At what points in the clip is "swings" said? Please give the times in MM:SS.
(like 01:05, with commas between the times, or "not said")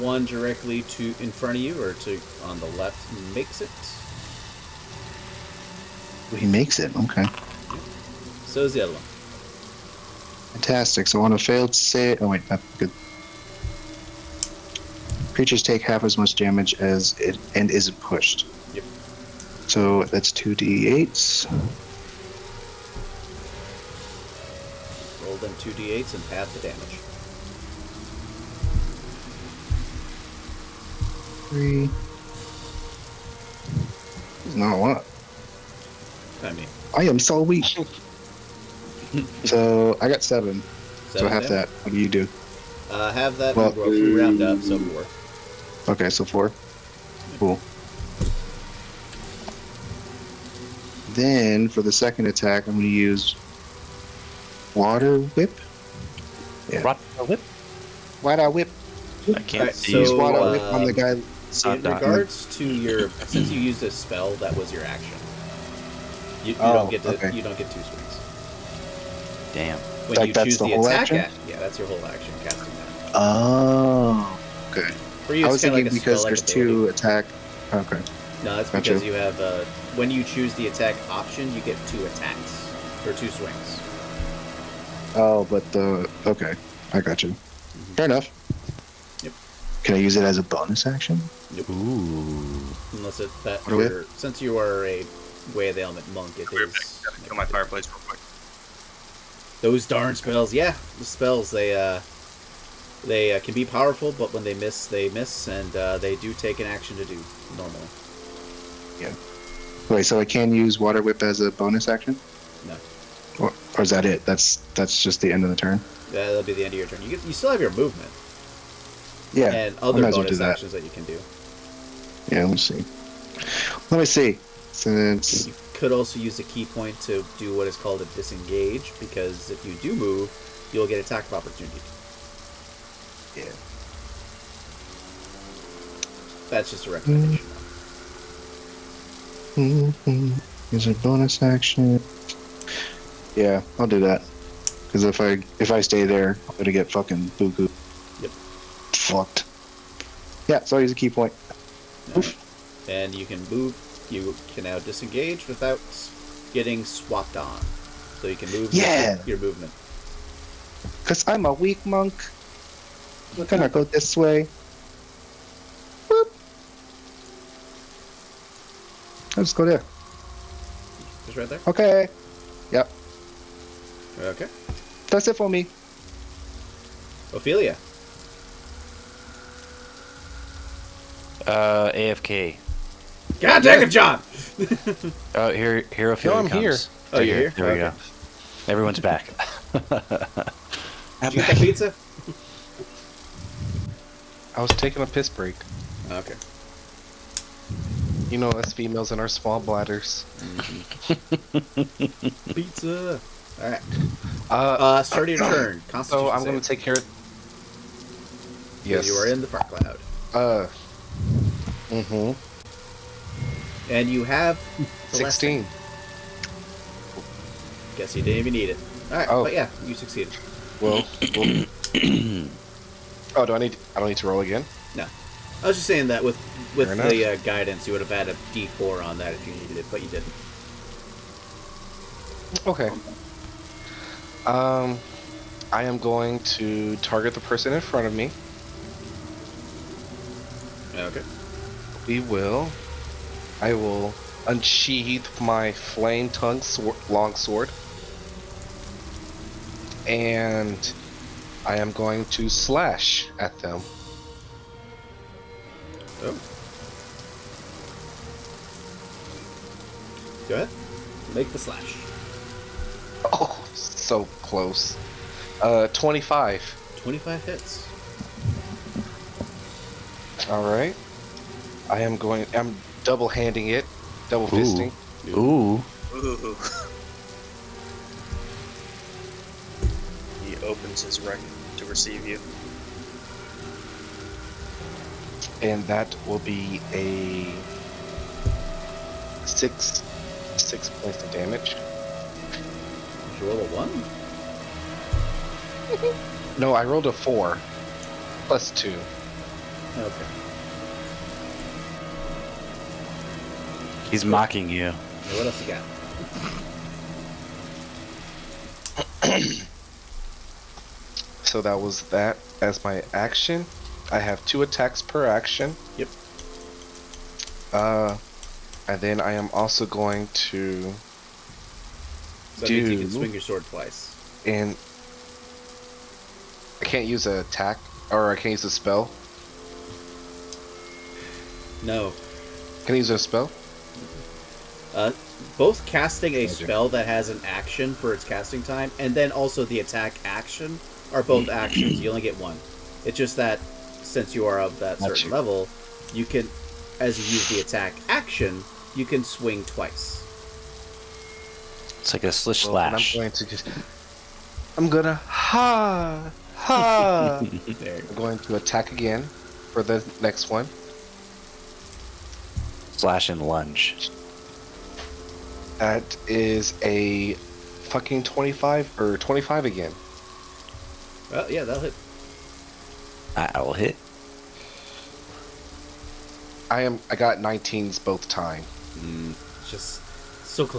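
01:07, 01:23, 05:23, 05:49.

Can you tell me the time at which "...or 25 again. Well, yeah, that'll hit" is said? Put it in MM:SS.
06:08.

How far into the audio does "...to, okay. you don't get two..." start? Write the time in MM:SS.
01:07.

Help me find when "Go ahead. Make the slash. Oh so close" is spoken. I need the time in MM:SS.
04:20.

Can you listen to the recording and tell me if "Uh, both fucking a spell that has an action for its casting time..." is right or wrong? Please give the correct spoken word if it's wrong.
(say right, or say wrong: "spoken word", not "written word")
wrong: "casting", not "fucking".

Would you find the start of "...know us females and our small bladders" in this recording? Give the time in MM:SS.
03:18.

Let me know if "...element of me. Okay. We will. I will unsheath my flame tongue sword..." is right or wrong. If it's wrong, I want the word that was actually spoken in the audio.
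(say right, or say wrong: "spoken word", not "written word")
wrong: "front", not "element".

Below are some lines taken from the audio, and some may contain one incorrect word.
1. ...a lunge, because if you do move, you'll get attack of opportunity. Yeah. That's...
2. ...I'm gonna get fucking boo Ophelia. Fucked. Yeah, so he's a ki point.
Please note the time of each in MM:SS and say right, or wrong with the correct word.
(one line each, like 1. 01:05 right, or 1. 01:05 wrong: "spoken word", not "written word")
1. 02:08 wrong: "disengage", not "lunge"
2. 02:26 wrong: "Yep", not "Ophelia".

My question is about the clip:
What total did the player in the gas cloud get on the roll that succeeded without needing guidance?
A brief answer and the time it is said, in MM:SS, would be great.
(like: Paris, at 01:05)
16, at 03:35.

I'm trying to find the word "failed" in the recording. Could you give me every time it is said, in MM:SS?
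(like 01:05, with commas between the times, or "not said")
00:11.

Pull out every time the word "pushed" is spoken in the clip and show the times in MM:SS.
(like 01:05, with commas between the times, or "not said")
00:17.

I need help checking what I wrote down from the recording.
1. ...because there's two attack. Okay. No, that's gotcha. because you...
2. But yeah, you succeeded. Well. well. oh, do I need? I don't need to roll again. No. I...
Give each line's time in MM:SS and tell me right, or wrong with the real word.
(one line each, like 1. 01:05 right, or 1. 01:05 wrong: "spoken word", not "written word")
1. 01:15 right
2. 03:39 right.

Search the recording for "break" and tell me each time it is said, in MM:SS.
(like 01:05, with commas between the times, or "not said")
03:15.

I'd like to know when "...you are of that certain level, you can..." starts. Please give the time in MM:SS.
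05:44.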